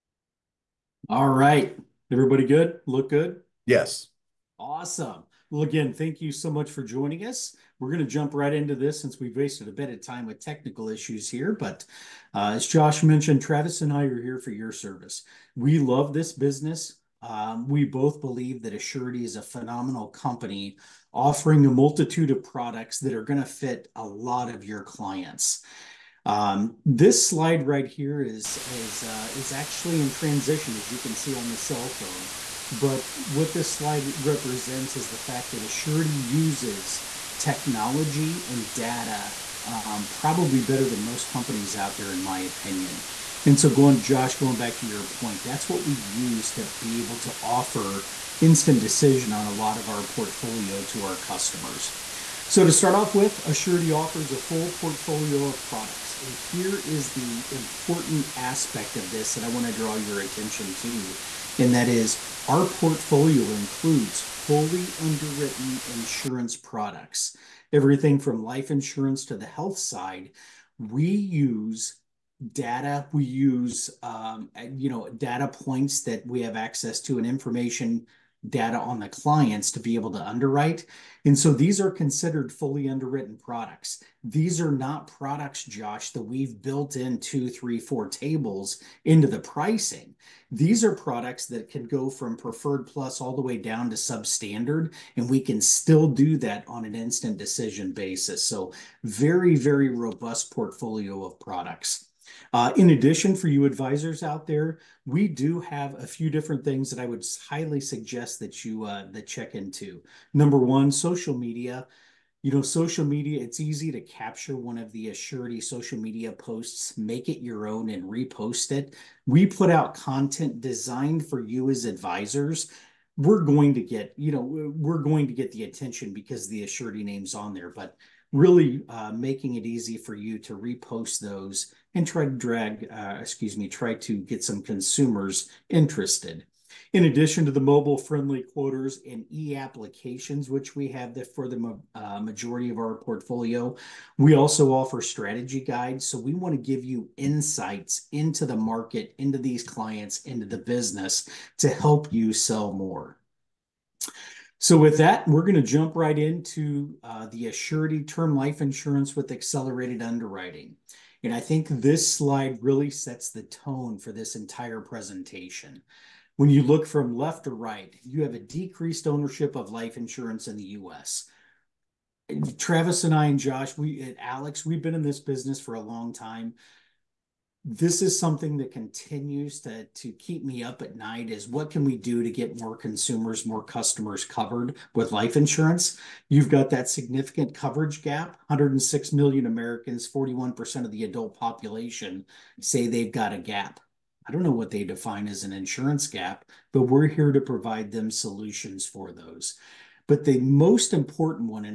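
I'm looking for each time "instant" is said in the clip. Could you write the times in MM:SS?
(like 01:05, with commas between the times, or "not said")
00:48, 01:36.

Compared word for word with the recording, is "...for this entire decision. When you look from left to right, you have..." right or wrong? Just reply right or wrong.
wrong.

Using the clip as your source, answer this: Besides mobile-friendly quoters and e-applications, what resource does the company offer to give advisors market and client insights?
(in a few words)
strategy guides.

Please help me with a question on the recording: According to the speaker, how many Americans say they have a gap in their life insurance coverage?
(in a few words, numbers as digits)
106 million.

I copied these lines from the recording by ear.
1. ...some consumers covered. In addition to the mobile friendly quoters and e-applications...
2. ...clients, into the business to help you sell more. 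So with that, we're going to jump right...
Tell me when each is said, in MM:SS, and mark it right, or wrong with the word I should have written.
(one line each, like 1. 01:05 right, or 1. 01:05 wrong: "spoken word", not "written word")
1. 02:14 wrong: "interested", not "covered"
2. 02:29 right.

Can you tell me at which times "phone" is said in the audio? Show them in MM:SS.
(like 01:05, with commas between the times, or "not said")
00:31.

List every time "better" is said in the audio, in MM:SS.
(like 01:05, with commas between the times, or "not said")
00:40.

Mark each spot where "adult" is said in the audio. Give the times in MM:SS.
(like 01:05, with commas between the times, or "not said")
03:11.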